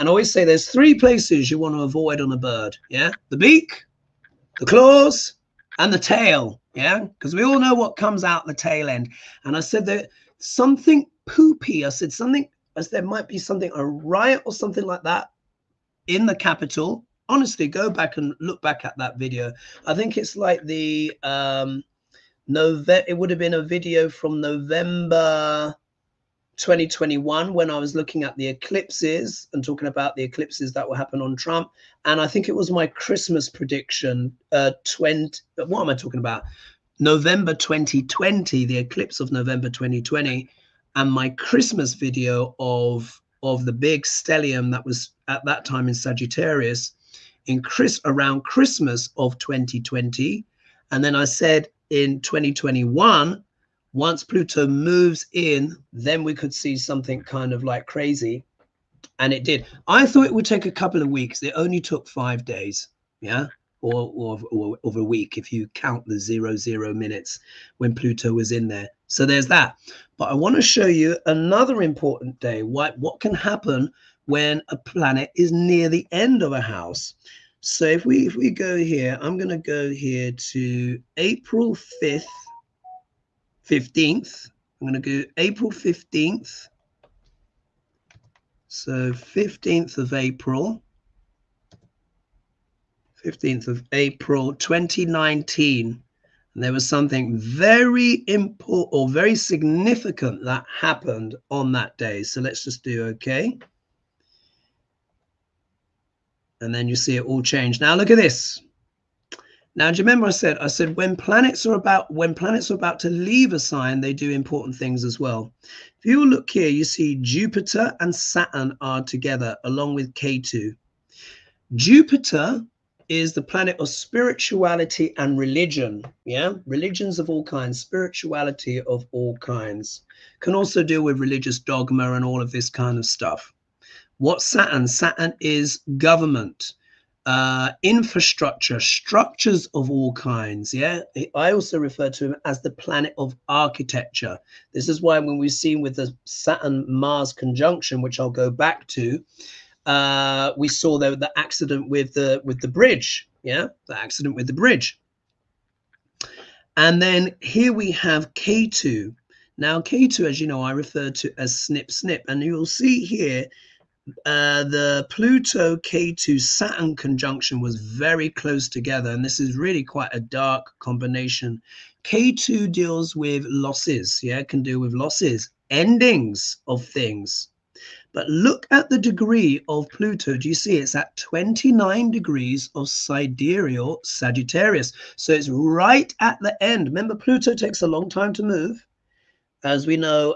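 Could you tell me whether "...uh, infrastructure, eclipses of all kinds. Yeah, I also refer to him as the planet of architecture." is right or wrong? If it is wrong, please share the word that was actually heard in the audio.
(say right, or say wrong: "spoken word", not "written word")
wrong: "structures", not "eclipses".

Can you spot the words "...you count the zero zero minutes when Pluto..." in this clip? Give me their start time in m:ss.
1:05.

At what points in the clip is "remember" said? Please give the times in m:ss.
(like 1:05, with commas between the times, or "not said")
1:50, 3:06.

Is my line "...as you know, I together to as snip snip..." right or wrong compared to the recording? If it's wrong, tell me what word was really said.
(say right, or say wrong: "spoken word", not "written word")
wrong: "refer", not "together".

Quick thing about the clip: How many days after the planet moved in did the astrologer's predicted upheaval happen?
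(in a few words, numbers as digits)
5.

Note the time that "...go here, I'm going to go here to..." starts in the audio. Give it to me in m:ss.
1:18.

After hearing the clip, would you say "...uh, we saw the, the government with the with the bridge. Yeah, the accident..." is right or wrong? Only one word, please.
wrong.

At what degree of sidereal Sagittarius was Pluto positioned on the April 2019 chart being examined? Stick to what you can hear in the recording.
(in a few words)
29 degrees.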